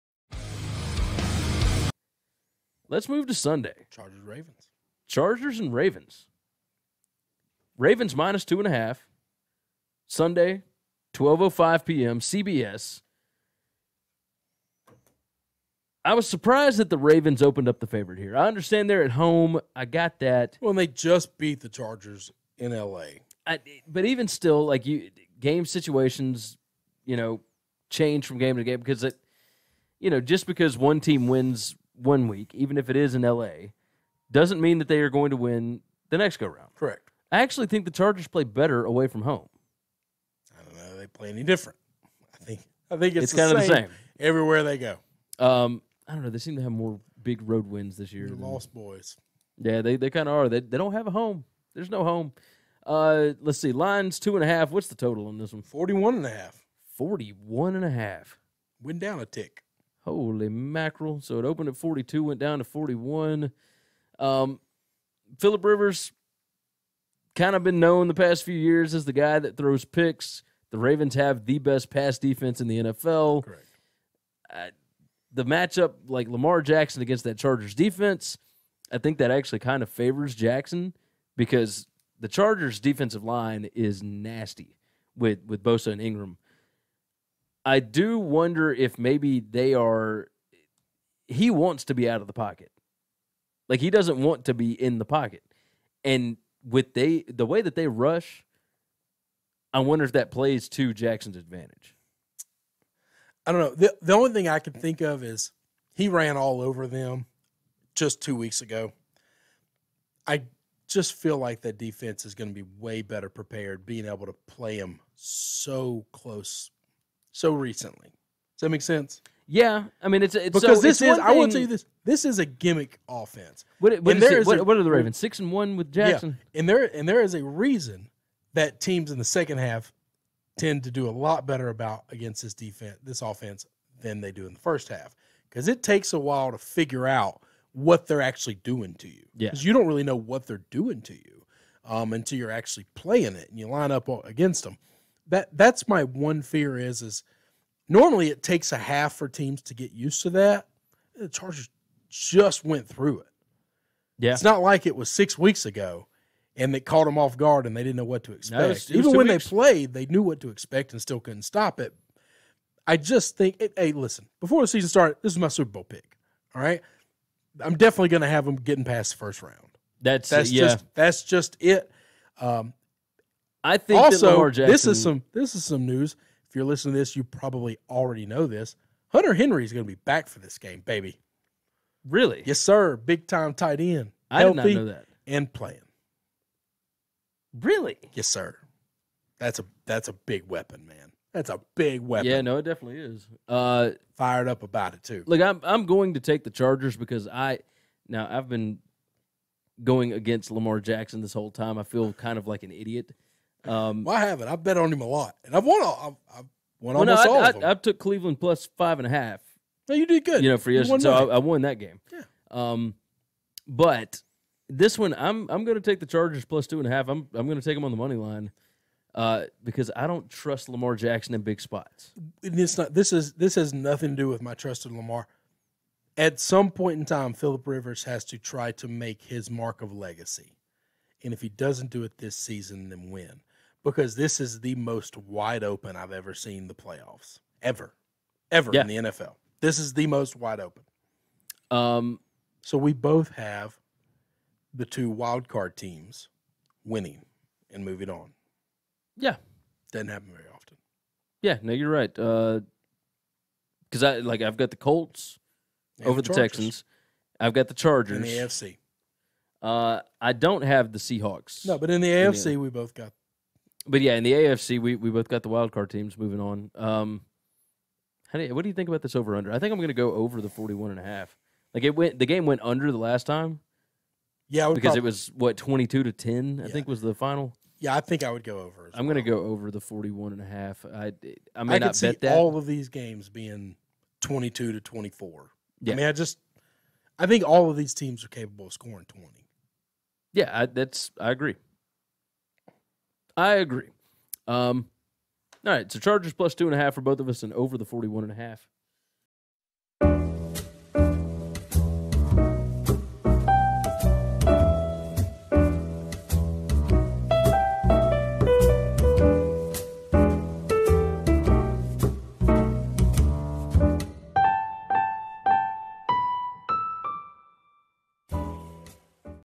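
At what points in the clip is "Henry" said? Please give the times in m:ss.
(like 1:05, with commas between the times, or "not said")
2:59.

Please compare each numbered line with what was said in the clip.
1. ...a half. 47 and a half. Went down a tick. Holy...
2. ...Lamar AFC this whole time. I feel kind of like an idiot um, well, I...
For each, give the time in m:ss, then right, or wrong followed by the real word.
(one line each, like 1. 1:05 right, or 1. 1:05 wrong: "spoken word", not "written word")
1. 0:56 wrong: "41", not "47"
2. 3:20 wrong: "Jackson", not "AFC".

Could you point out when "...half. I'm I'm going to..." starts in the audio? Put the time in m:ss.
3:36.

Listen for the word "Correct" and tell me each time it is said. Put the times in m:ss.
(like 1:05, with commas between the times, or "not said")
0:36, 1:13.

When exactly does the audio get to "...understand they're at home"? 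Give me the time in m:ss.
0:18.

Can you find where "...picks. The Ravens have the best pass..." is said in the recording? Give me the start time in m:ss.
1:09.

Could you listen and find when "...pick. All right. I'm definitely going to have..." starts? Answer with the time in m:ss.
2:45.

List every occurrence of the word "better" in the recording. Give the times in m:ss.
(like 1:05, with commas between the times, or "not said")
0:38, 1:53, 2:11.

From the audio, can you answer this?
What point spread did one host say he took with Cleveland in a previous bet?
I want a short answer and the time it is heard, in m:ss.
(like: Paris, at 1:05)
plus 5.5, at 3:28.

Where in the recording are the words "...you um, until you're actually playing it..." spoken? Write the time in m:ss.
2:21.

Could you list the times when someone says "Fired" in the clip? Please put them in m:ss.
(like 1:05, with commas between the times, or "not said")
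3:14.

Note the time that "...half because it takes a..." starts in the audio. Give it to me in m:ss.
2:14.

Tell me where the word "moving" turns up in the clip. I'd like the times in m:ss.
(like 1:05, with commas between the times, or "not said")
4:07, 4:26.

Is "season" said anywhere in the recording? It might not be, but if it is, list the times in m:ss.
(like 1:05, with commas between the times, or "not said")
2:44, 3:52.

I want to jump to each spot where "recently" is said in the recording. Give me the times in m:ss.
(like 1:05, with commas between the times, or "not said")
1:57.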